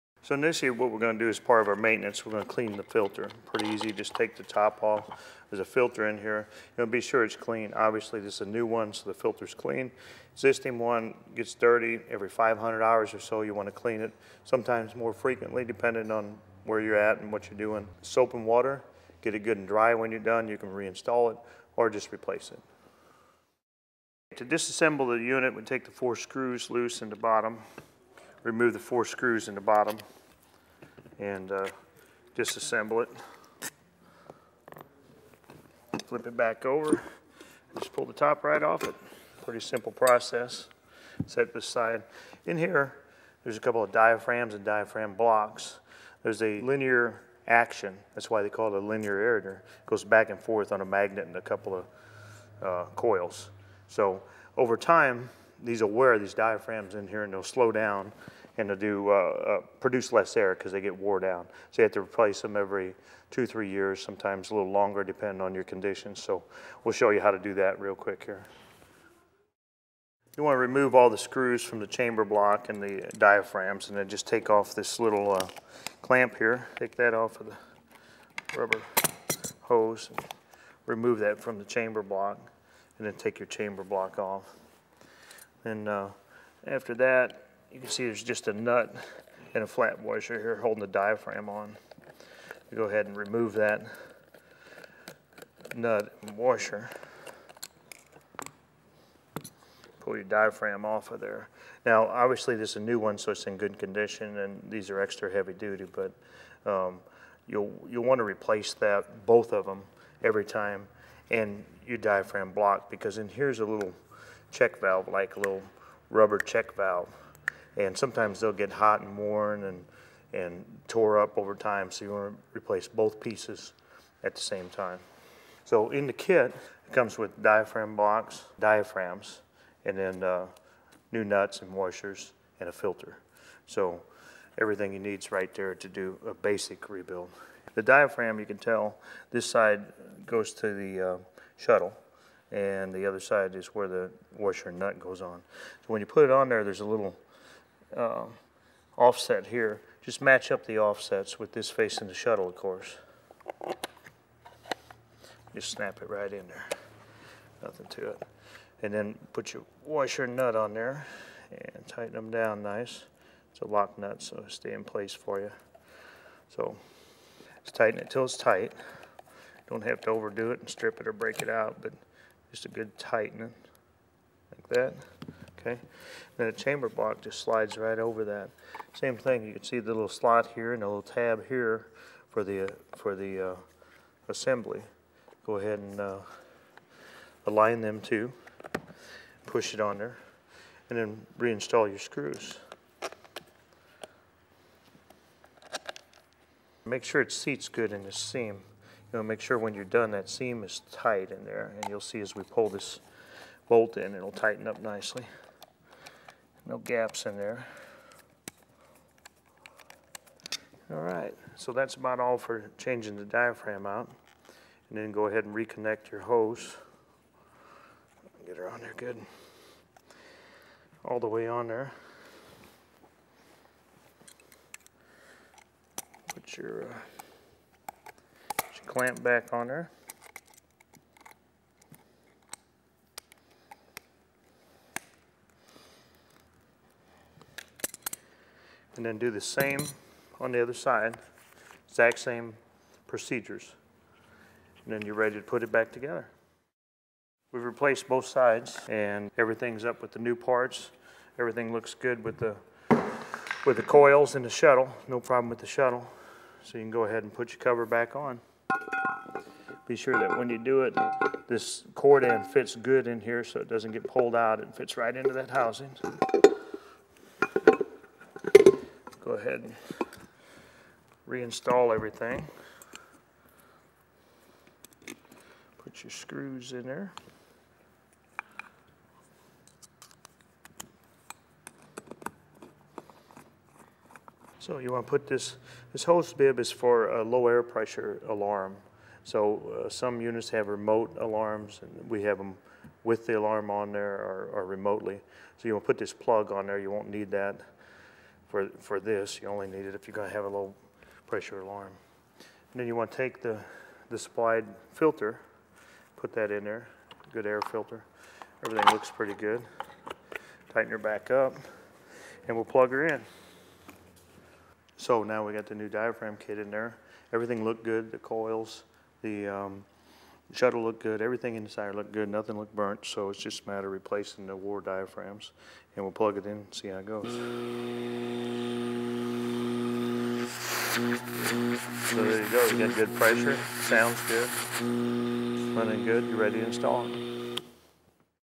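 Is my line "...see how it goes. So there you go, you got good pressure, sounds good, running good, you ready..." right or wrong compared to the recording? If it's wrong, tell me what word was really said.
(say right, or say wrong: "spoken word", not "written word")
right.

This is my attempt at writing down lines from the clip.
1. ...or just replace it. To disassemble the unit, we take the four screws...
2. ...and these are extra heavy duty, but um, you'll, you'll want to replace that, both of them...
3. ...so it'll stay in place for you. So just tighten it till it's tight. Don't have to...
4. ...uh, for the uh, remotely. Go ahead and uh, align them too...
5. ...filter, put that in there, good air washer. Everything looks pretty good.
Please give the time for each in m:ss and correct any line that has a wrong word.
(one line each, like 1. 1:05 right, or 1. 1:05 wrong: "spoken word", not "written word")
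1. 0:21 right
2. 1:44 right
3. 2:44 right
4. 3:02 wrong: "assembly", not "remotely"
5. 5:04 wrong: "filter", not "washer".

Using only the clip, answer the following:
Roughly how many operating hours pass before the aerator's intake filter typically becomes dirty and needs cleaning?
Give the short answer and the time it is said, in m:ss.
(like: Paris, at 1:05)
500 hours, at 0:12.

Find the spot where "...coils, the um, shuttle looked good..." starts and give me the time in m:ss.
5:18.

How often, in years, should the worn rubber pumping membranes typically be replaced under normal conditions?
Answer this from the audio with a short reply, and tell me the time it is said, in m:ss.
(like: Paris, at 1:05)
2 to 3 years, at 1:03.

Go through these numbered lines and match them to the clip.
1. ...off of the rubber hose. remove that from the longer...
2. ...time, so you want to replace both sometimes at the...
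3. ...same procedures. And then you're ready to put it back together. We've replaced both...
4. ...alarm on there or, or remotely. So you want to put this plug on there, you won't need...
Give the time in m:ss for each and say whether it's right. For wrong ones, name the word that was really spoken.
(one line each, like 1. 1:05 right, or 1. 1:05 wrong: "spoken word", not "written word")
1. 1:17 wrong: "chamber", not "longer"
2. 2:01 wrong: "pieces", not "sometimes"
3. 4:02 right
4. 4:53 right.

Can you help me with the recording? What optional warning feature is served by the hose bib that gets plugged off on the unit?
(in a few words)
low air pressure alarm.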